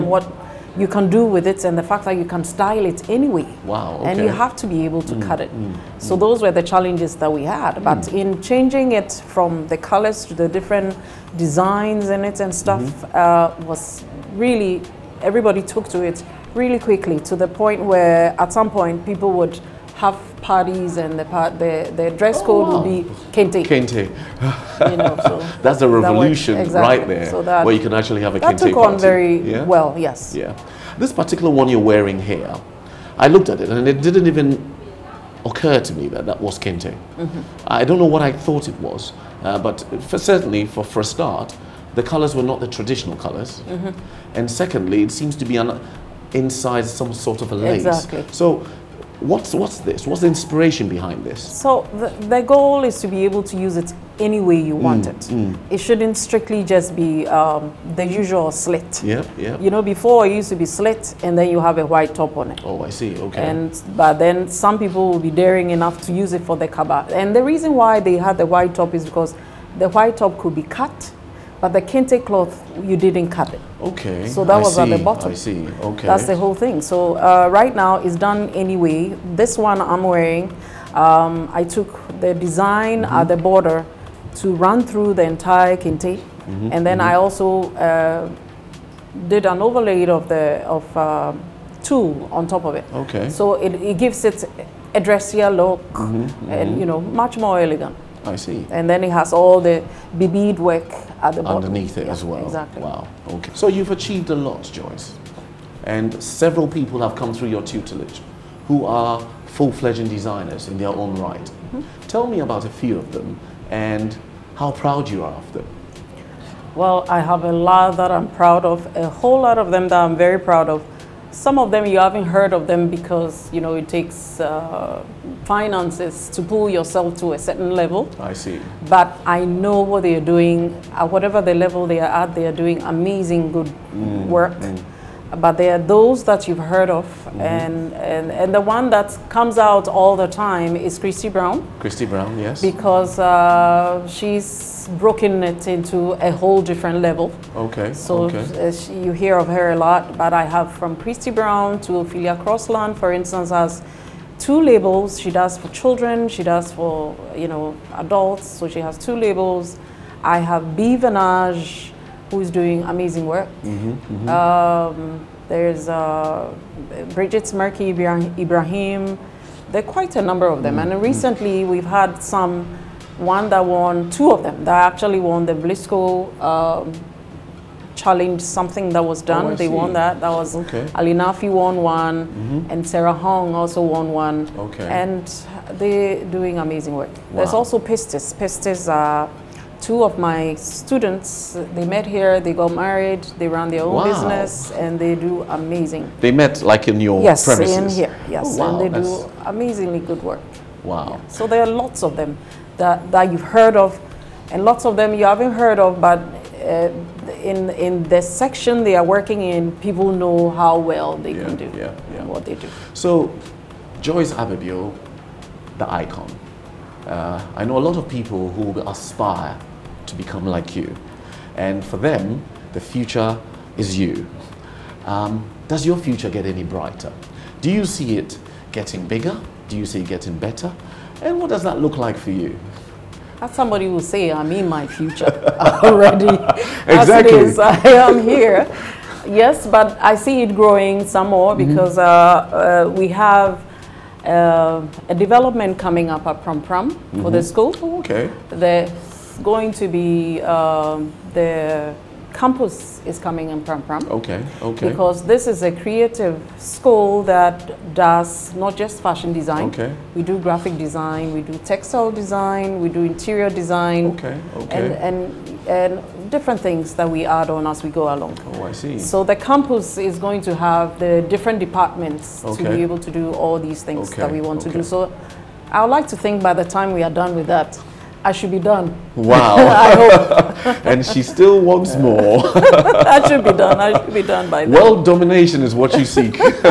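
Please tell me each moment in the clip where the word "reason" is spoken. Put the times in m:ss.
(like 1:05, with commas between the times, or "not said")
1:07.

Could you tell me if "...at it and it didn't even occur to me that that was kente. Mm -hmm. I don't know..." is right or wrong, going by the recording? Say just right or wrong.
right.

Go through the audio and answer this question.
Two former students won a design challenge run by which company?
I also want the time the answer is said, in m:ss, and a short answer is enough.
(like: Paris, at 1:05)
Vlisco, at 2:55.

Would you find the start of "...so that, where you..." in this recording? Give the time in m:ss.
0:27.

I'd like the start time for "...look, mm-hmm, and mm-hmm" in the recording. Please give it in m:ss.
1:35.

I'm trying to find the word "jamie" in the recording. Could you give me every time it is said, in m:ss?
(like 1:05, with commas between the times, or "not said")
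not said.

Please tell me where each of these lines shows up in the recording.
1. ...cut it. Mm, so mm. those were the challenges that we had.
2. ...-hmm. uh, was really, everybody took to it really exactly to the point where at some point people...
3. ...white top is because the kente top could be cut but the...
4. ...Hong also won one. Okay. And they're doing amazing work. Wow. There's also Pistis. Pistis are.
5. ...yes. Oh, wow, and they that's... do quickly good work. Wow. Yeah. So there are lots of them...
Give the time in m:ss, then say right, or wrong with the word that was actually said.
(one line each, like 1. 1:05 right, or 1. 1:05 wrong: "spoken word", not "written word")
1. 0:05 right
2. 0:12 wrong: "quickly", not "exactly"
3. 1:08 wrong: "white", not "kente"
4. 3:03 right
5. 3:18 wrong: "amazingly", not "quickly".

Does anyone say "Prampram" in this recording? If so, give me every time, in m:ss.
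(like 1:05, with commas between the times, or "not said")
4:06, 4:13.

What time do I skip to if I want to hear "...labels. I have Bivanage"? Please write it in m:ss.
2:39.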